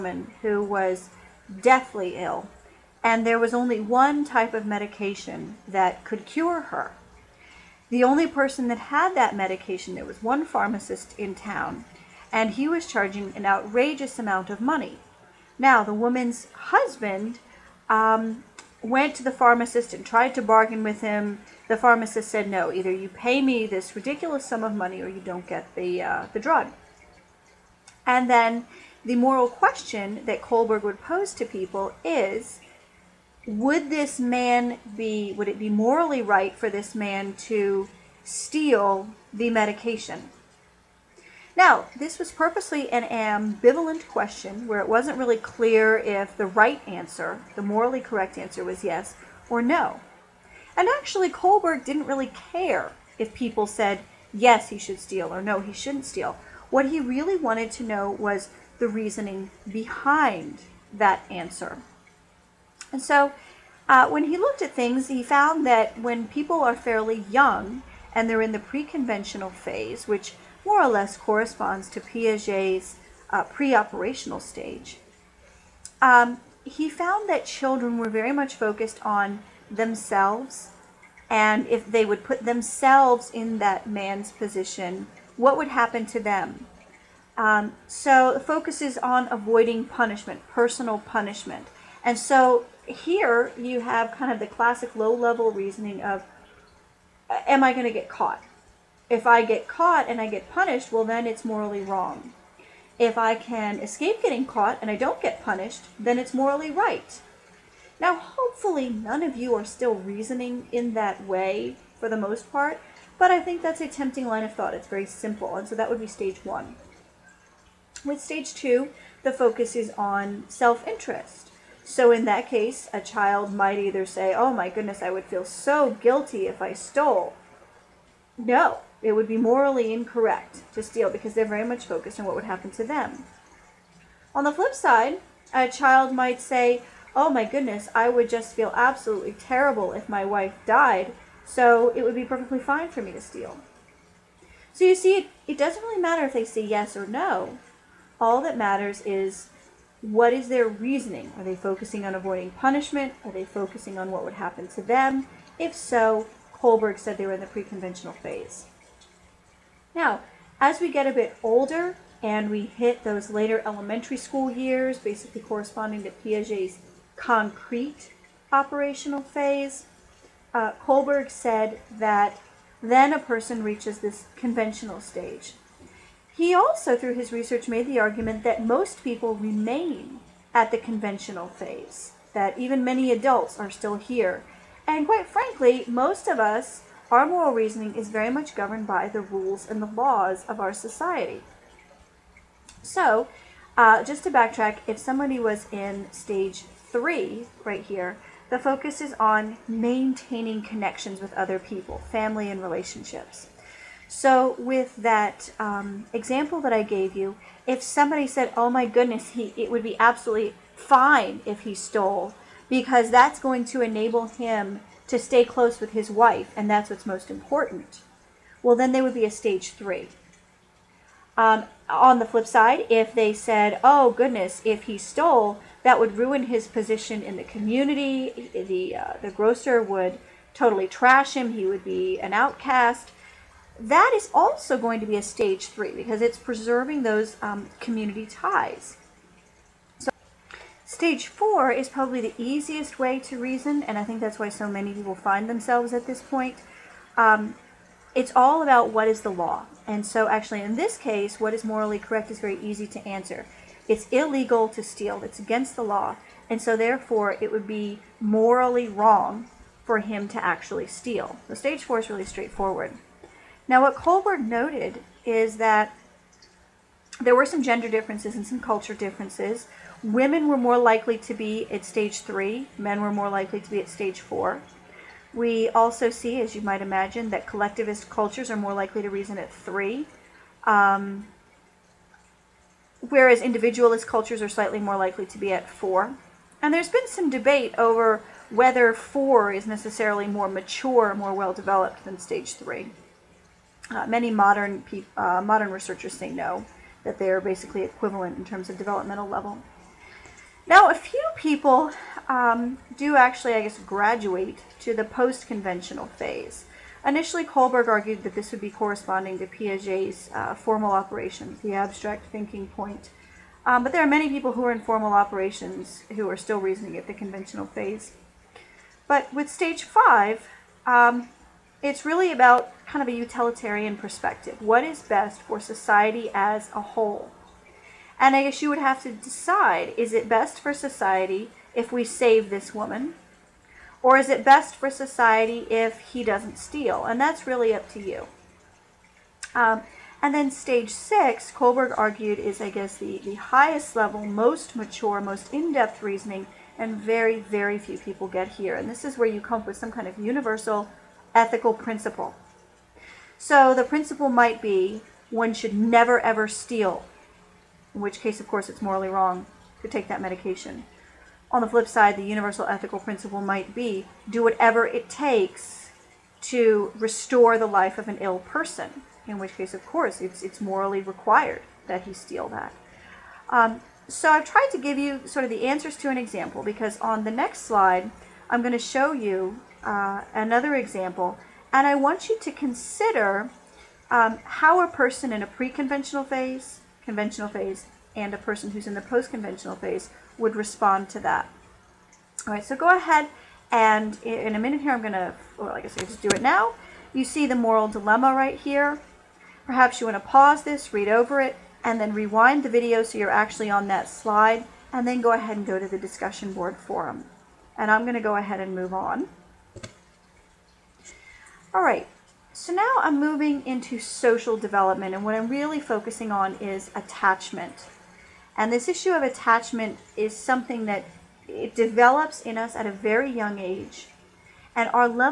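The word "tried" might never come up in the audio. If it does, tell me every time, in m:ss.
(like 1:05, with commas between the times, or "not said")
0:20, 6:14.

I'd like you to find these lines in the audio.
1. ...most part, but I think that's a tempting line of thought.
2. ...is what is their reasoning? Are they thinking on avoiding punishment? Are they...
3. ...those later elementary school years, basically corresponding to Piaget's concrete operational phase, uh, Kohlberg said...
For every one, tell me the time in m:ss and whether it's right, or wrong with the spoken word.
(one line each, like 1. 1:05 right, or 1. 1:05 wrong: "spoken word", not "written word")
1. 1:52 right
2. 2:29 wrong: "focusing", not "thinking"
3. 2:43 right.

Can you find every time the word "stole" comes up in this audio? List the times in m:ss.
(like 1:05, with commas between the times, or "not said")
2:06, 3:31, 3:44.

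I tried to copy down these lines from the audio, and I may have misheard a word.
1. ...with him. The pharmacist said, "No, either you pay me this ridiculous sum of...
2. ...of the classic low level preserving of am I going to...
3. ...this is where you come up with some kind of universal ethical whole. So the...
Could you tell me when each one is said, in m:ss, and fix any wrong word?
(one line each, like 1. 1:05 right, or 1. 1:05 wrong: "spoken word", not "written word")
1. 0:20 right
2. 1:34 wrong: "reasoning", not "preserving"
3. 5:48 wrong: "principle", not "whole".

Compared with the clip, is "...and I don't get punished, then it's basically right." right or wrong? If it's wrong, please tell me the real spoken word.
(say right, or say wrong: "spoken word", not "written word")
wrong: "morally", not "basically".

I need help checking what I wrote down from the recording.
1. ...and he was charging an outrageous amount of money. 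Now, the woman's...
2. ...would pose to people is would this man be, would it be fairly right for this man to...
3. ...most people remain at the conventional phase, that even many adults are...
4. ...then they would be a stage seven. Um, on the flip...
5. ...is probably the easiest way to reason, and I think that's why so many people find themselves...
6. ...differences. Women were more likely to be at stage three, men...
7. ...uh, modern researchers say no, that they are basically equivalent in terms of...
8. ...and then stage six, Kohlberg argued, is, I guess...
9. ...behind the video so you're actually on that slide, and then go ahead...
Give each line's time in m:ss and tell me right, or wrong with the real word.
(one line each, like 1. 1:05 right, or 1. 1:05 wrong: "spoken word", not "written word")
1. 0:12 right
2. 0:30 wrong: "morally", not "fairly"
3. 2:58 right
4. 3:38 wrong: "three", not "seven"
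5. 4:01 right
6. 4:28 right
7. 4:55 right
8. 5:40 right
9. 6:42 wrong: "rewind", not "behind".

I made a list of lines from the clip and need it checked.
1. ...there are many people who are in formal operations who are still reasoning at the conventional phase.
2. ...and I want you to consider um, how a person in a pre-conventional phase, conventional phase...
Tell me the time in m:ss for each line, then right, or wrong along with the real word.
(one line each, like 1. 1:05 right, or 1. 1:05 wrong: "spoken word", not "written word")
1. 5:13 right
2. 6:21 right.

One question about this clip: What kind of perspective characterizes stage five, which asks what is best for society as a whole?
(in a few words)
utilitarian.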